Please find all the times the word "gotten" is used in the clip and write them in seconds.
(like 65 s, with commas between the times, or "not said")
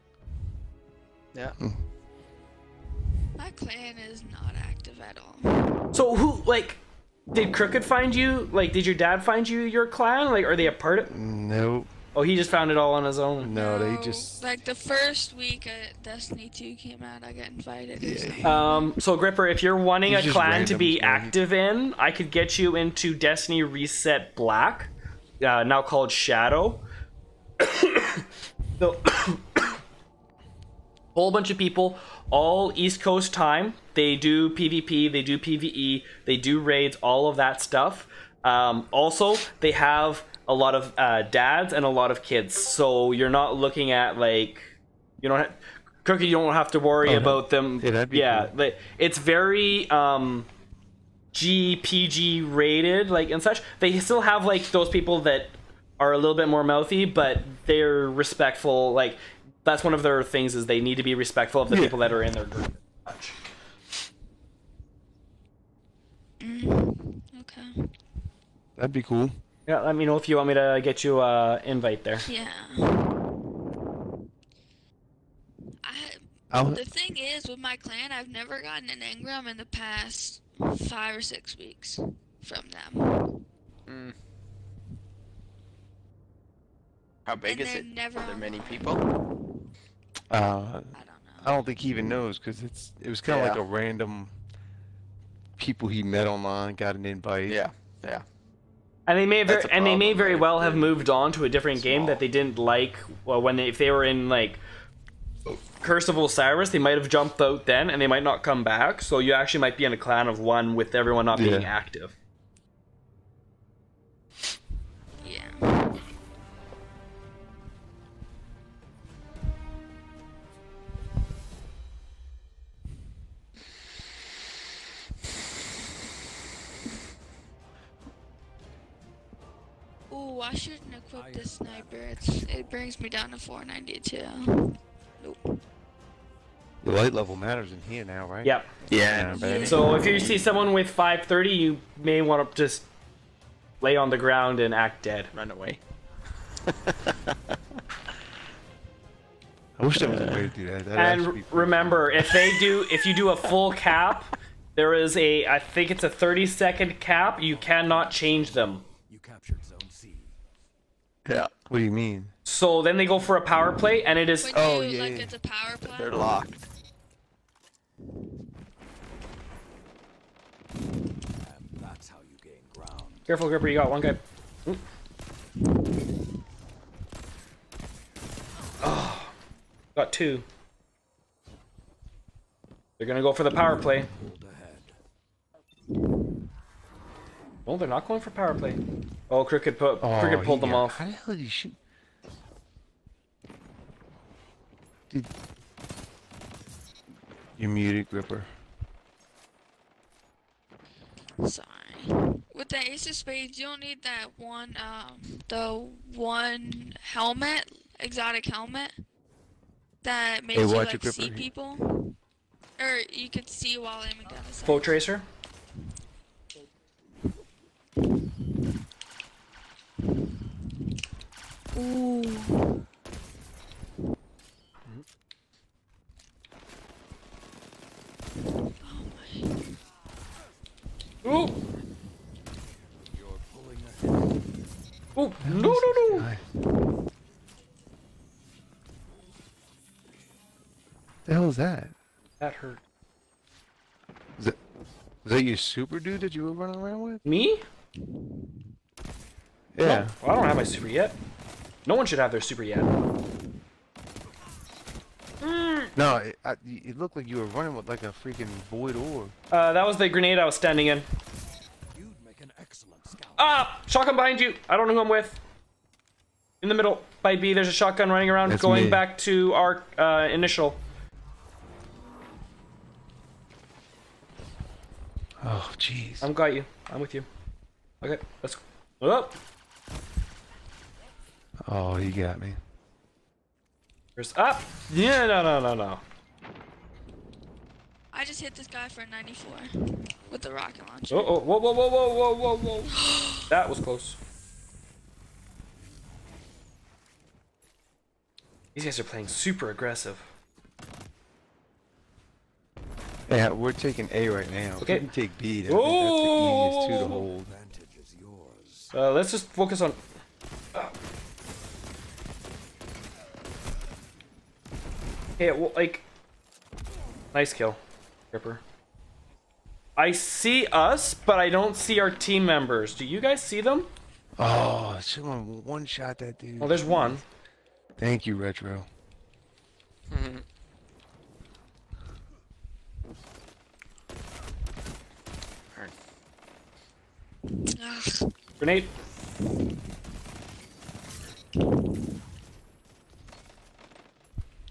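78 s.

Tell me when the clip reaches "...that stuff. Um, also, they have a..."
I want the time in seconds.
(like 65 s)
37 s.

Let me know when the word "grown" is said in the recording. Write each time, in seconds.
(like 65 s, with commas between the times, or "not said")
not said.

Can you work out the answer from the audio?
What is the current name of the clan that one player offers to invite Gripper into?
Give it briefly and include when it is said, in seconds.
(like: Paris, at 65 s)
Shadow, at 25 s.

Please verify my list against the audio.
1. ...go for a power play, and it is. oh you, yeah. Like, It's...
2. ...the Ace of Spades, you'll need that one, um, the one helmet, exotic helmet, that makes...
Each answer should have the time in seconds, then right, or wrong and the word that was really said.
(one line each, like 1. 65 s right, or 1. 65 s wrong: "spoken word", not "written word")
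1. 163 s right
2. 202 s right.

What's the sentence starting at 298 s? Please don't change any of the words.
These guys are playing super aggressive.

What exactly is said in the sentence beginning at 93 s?
like a random people he met online got an invite.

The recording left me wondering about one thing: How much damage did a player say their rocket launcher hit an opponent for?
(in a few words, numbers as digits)
94.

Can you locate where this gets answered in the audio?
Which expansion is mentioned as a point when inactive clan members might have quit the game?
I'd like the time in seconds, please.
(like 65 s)
105 s.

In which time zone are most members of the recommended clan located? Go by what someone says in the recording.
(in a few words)
East Coast.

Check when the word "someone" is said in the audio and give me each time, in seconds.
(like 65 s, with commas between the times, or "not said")
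140 s, 325 s.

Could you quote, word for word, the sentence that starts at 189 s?
Oh, Cricket, put, oh, Cricket pulled them off.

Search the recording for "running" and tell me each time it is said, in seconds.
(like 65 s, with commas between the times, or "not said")
246 s, 257 s, 268 s.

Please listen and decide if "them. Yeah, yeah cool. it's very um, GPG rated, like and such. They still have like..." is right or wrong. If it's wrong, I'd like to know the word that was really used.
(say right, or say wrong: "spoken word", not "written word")
right.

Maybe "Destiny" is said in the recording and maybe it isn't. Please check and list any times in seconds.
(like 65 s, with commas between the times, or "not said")
16 s, 23 s.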